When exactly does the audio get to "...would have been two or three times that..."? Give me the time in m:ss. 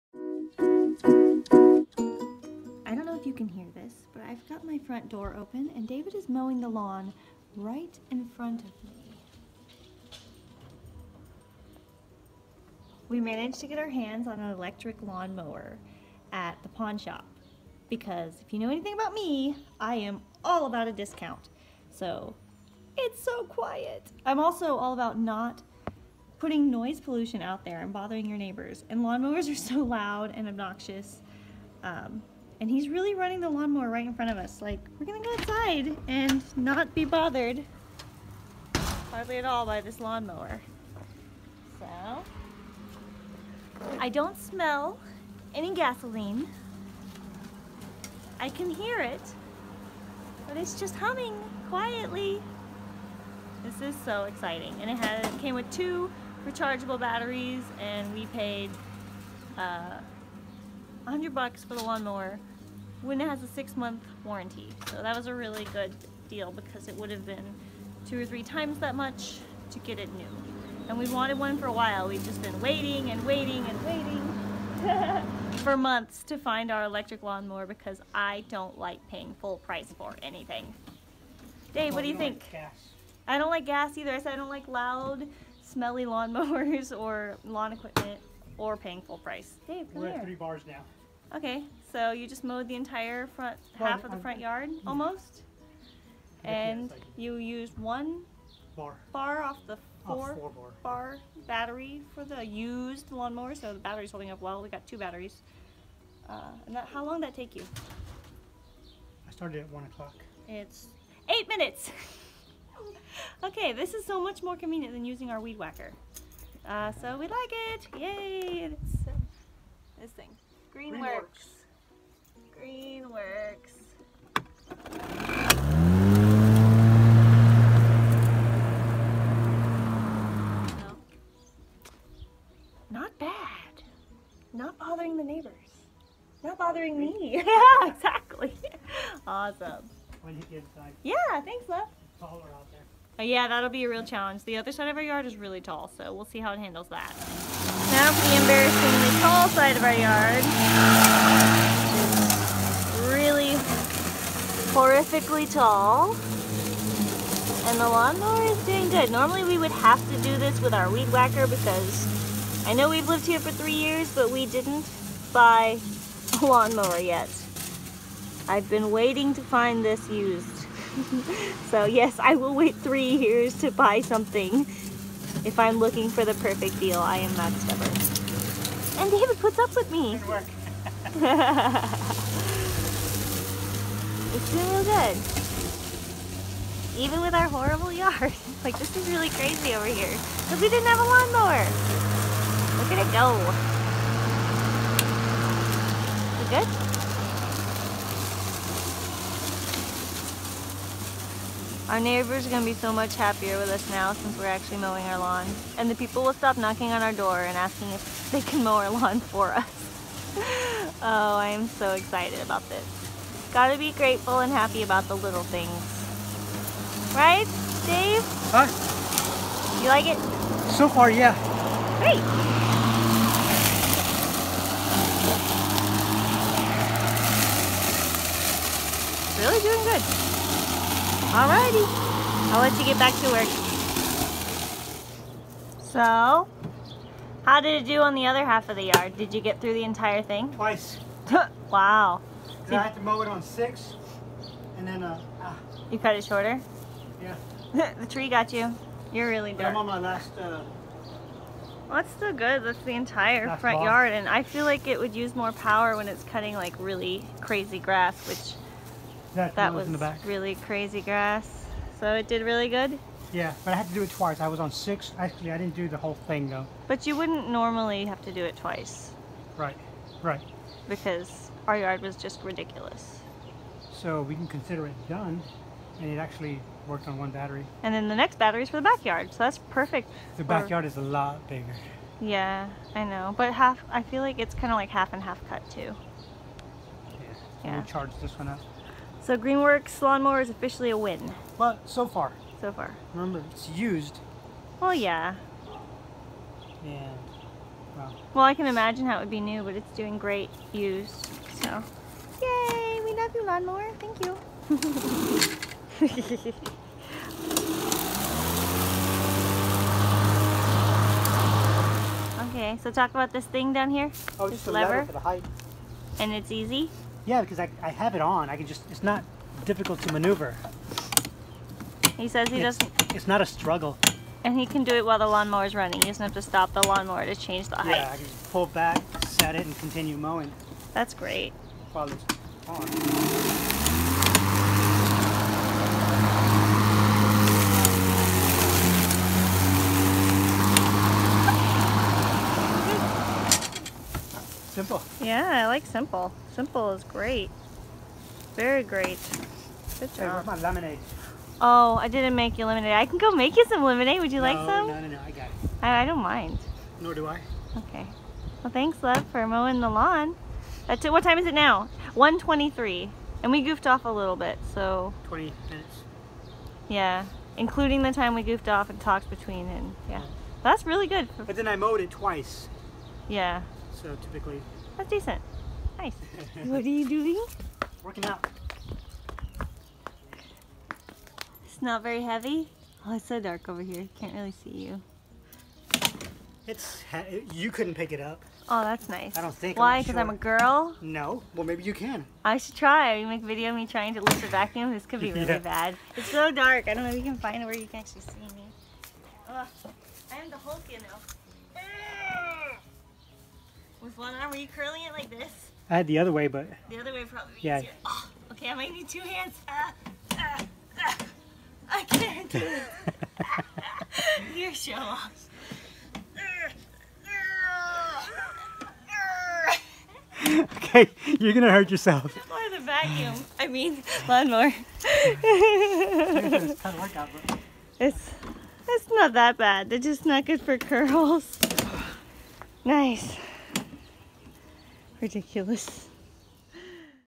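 1:06.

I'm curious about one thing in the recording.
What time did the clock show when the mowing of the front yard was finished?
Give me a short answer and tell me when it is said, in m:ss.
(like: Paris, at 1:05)
1:23, at 6:02.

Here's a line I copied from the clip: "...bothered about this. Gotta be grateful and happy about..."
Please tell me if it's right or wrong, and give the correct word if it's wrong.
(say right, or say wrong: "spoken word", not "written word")
wrong: "excited", not "bothered".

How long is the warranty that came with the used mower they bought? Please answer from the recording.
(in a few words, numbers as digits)
6 months.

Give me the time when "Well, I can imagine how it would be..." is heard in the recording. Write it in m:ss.
4:58.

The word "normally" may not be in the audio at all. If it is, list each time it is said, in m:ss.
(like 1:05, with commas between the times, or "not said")
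2:39, 4:27.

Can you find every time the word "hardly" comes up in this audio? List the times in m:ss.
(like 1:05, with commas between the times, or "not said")
0:39.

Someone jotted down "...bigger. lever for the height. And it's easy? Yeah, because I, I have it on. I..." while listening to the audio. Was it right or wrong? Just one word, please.
wrong.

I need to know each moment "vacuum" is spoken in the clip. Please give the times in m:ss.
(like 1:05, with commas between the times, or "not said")
6:34, 7:02.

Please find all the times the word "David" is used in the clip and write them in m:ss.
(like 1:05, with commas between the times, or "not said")
0:05, 2:59.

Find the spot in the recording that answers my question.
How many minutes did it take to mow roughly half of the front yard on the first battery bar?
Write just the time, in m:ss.
1:50.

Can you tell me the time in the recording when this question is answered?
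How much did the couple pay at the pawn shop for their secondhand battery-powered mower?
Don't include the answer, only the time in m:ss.
1:01.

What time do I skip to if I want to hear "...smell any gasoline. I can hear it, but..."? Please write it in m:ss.
0:44.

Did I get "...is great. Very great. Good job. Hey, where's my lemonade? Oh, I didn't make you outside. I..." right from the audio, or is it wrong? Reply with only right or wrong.
wrong.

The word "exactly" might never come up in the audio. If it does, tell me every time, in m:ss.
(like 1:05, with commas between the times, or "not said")
2:17.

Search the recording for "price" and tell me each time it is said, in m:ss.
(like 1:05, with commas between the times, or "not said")
1:19, 1:29.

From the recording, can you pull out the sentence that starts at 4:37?
And then the next battery is for the backyard, so that's perfect.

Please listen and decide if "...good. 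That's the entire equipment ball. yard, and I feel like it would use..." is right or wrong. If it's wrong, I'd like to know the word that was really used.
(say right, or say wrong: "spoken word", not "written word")
wrong: "front", not "equipment".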